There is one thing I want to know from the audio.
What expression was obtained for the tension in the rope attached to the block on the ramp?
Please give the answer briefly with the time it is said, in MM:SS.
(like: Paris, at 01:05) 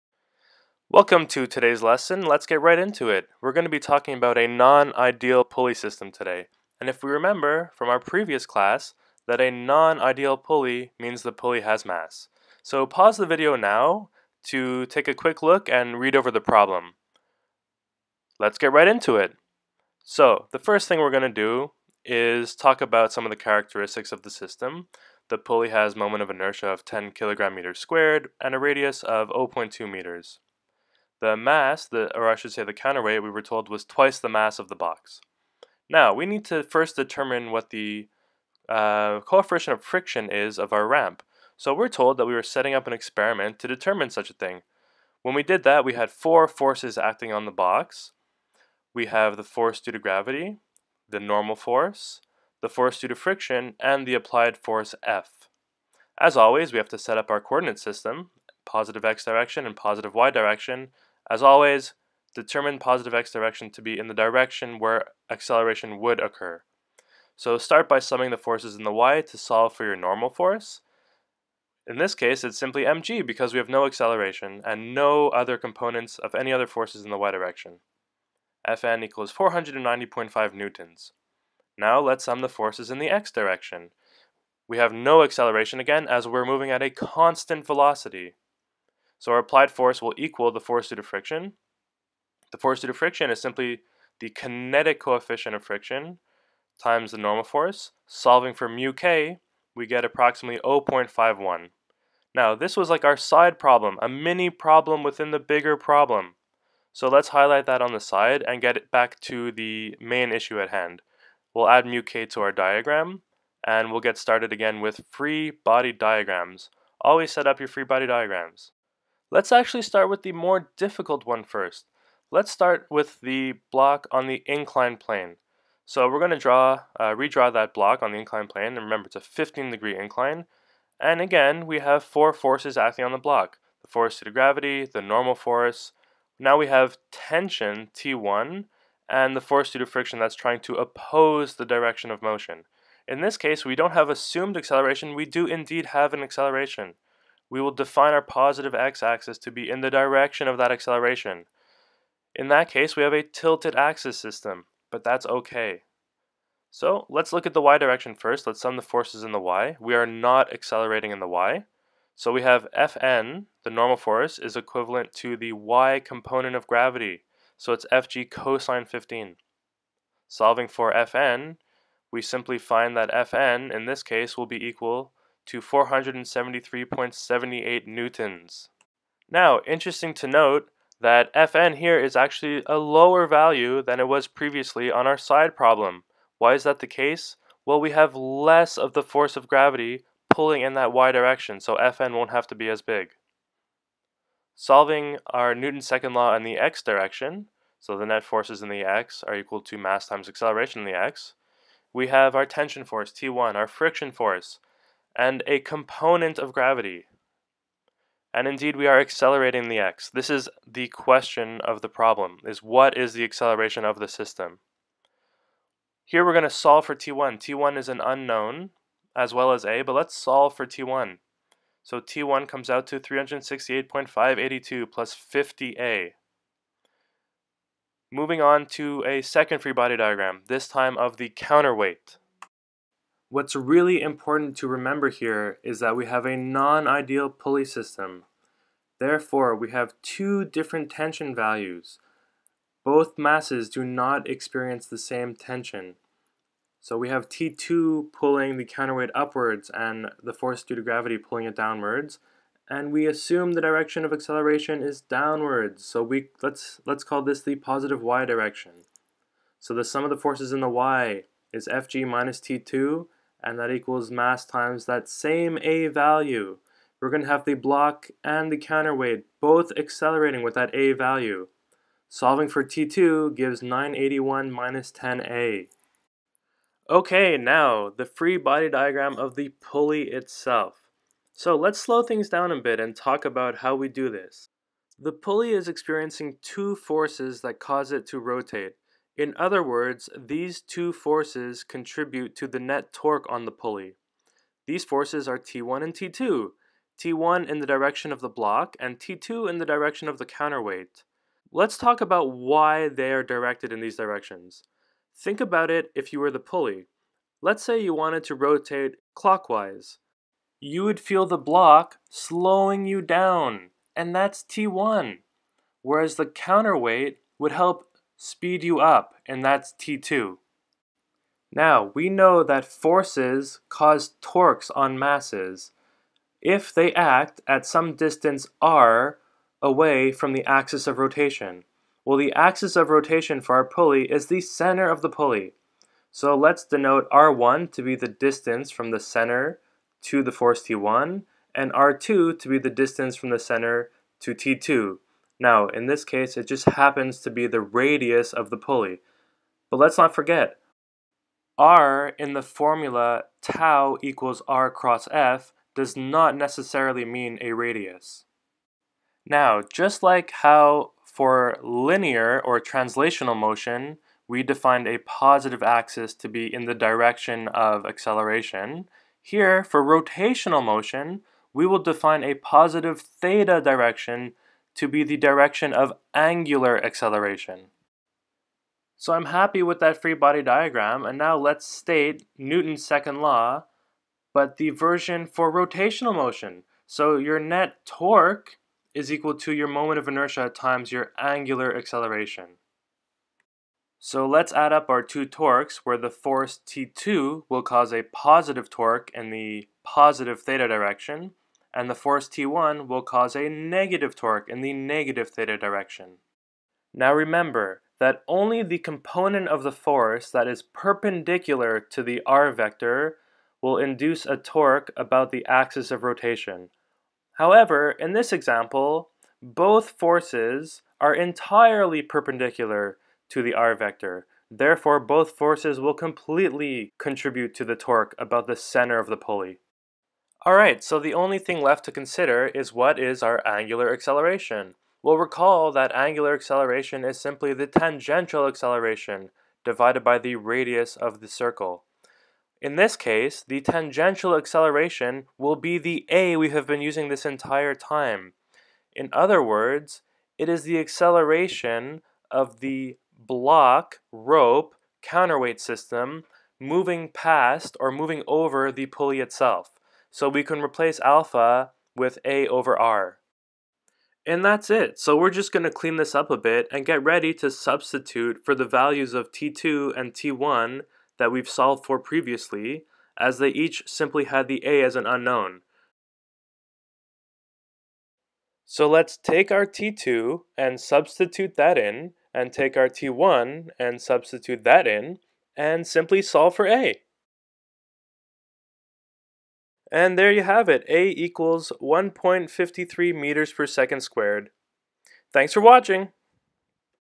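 368.582 + 50a, at 03:42.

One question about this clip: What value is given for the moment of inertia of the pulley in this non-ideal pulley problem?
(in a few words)
10 kg·m².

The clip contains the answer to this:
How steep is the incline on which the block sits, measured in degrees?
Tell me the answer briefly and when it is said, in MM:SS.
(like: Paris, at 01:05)
15 degrees, at 02:09.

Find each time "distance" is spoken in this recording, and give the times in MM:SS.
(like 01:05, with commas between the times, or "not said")
05:27, 05:38, 05:42.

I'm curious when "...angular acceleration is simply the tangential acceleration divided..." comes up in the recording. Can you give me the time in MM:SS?
07:15.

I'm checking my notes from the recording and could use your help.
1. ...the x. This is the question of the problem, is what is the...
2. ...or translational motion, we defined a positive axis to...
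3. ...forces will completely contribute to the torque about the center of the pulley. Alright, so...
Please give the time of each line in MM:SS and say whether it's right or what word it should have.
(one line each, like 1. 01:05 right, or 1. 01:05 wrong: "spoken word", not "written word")
1. 03:29 right
2. 06:02 right
3. 07:05 right.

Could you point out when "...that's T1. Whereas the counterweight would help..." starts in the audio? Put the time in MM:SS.
05:14.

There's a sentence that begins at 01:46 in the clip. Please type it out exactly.
So let's highlight that on the side and get it back to the main issue at hand.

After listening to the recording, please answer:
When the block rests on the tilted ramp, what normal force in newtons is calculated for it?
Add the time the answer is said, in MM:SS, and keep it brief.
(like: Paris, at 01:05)
473.78 newtons, at 02:55.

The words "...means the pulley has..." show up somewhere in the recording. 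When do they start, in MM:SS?
00:10.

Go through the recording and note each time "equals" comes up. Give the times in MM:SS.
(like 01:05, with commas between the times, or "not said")
01:19, 01:30, 02:54, 03:19, 04:23, 05:54, 06:29, 08:11.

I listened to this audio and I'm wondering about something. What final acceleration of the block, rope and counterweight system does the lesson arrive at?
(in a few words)
1.53 m/s².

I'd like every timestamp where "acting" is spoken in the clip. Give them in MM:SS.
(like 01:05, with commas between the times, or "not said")
00:46, 02:12.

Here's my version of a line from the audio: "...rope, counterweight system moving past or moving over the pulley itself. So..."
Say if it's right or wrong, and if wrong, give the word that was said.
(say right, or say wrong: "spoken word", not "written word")
right.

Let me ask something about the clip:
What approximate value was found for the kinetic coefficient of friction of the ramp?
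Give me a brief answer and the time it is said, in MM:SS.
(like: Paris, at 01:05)
0.51, at 01:40.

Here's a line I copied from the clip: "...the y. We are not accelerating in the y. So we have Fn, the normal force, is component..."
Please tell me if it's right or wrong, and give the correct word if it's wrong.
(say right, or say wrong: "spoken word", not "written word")
wrong: "equivalent", not "component".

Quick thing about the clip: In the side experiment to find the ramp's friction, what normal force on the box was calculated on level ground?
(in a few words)
490.5 newtons.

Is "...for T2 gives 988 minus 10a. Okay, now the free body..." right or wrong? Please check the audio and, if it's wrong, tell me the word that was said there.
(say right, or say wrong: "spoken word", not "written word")
wrong: "981", not "988".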